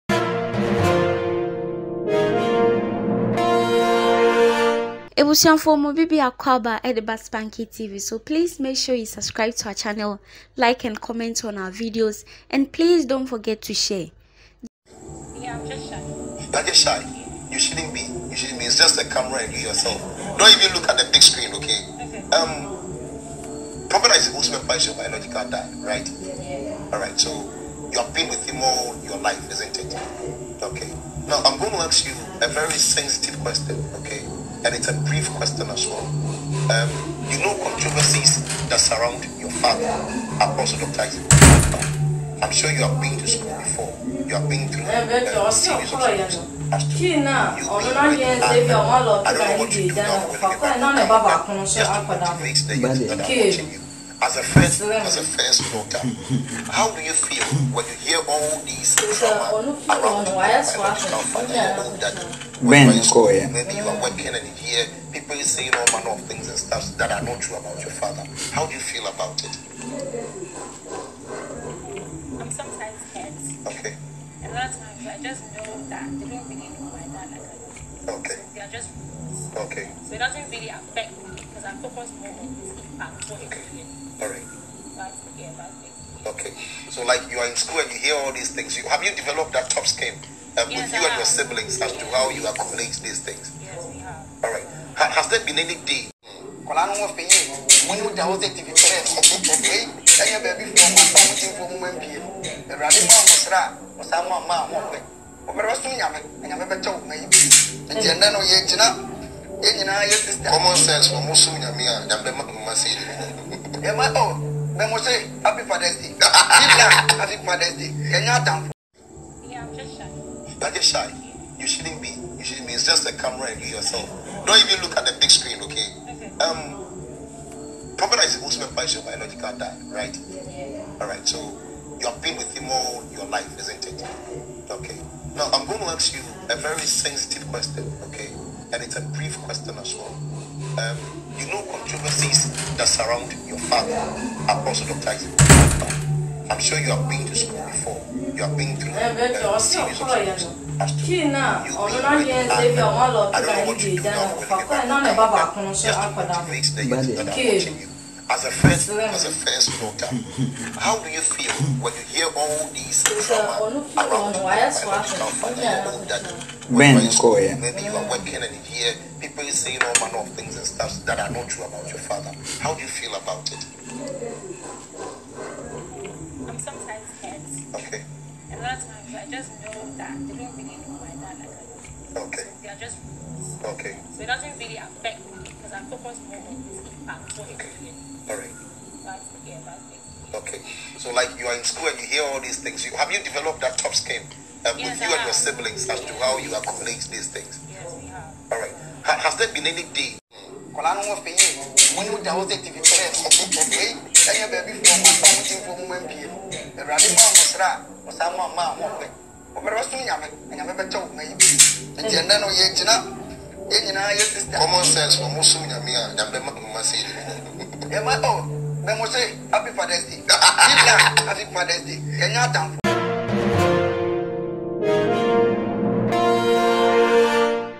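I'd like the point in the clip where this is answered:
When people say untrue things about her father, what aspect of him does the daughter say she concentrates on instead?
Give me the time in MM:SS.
01:22.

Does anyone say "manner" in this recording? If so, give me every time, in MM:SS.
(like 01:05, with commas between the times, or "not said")
01:05, 02:49.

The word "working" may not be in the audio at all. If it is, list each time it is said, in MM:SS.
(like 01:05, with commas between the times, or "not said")
01:04, 02:48.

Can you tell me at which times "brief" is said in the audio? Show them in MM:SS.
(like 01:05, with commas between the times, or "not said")
00:35, 02:19.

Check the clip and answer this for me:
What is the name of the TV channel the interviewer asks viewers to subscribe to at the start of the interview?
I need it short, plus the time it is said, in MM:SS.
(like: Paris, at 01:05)
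Baspanky TV, at 00:07.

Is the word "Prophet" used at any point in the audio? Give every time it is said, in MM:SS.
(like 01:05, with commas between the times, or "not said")
00:23, 02:07.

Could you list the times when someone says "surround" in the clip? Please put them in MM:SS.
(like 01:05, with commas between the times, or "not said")
00:38, 02:22.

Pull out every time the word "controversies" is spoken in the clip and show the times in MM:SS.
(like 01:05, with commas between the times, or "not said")
00:37, 02:21.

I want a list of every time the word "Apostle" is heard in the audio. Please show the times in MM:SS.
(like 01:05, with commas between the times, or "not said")
00:40, 02:24.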